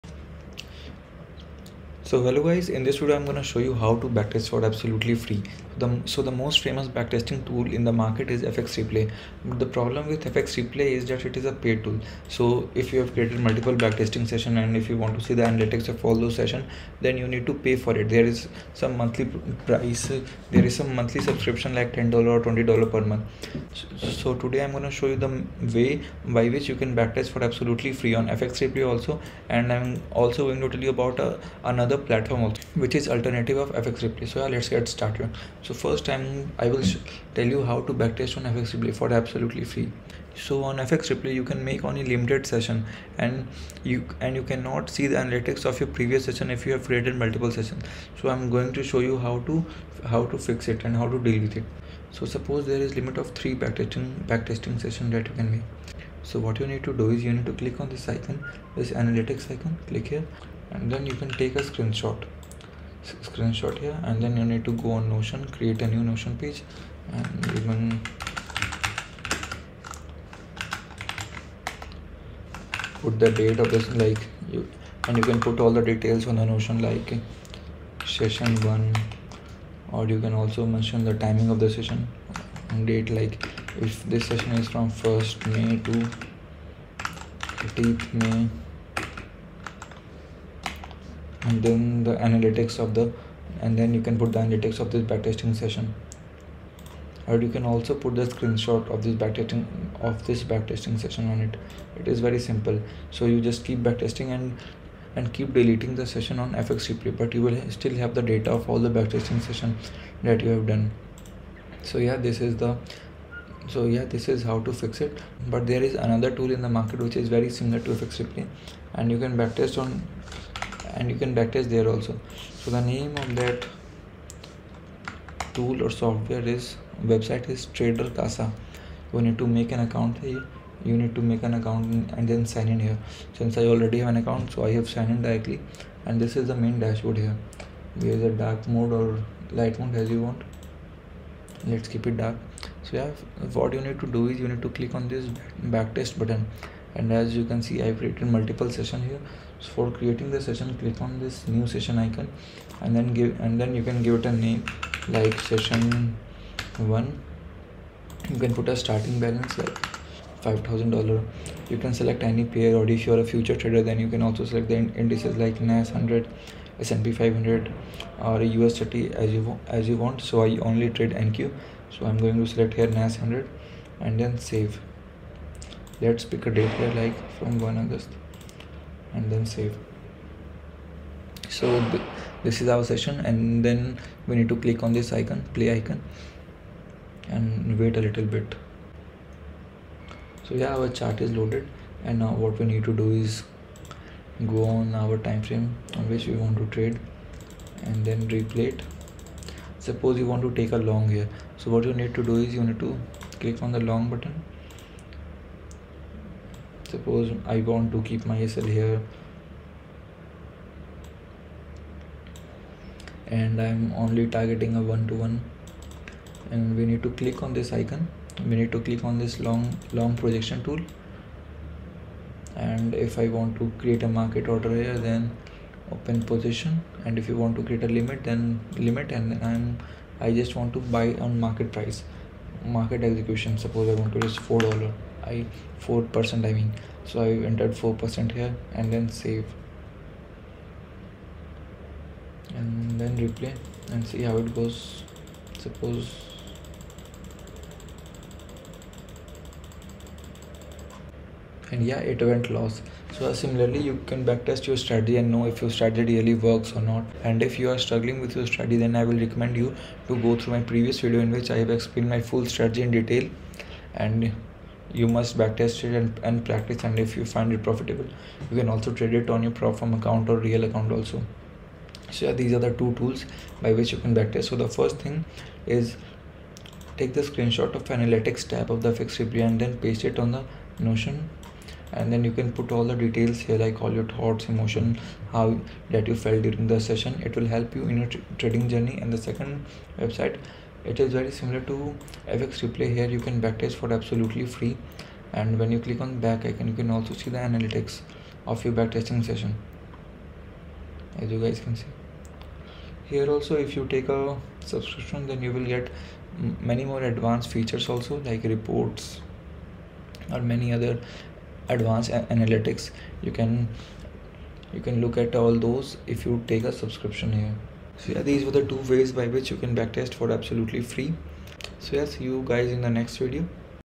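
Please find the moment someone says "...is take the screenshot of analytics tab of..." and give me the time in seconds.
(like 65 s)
275 s.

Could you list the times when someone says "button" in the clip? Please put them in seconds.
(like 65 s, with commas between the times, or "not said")
146 s, 204 s.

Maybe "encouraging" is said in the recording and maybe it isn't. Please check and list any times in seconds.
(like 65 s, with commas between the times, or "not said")
not said.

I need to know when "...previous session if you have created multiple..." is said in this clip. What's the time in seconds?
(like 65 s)
45 s.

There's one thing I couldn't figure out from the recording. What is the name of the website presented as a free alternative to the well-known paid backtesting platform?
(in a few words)
Trader Casa.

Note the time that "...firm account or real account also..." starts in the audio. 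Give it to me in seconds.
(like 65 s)
269 s.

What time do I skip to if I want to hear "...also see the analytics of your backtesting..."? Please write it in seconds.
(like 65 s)
296 s.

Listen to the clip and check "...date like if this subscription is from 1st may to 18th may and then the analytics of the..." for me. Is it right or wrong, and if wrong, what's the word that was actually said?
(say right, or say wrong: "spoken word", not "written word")
wrong: "session", not "subscription".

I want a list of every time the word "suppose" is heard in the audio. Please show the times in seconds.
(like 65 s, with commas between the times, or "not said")
52 s, 199 s, 206 s, 233 s, 245 s.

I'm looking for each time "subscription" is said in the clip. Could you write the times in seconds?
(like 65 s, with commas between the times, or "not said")
21 s, 304 s, 316 s.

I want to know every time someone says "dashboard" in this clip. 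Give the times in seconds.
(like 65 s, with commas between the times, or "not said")
136 s.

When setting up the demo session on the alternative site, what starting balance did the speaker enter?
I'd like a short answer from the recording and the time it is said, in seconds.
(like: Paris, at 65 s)
$5000, at 160 s.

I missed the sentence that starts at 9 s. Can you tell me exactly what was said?
But the problem with FX Replay is that it is a paid tool.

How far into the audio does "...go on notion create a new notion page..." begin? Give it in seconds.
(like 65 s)
64 s.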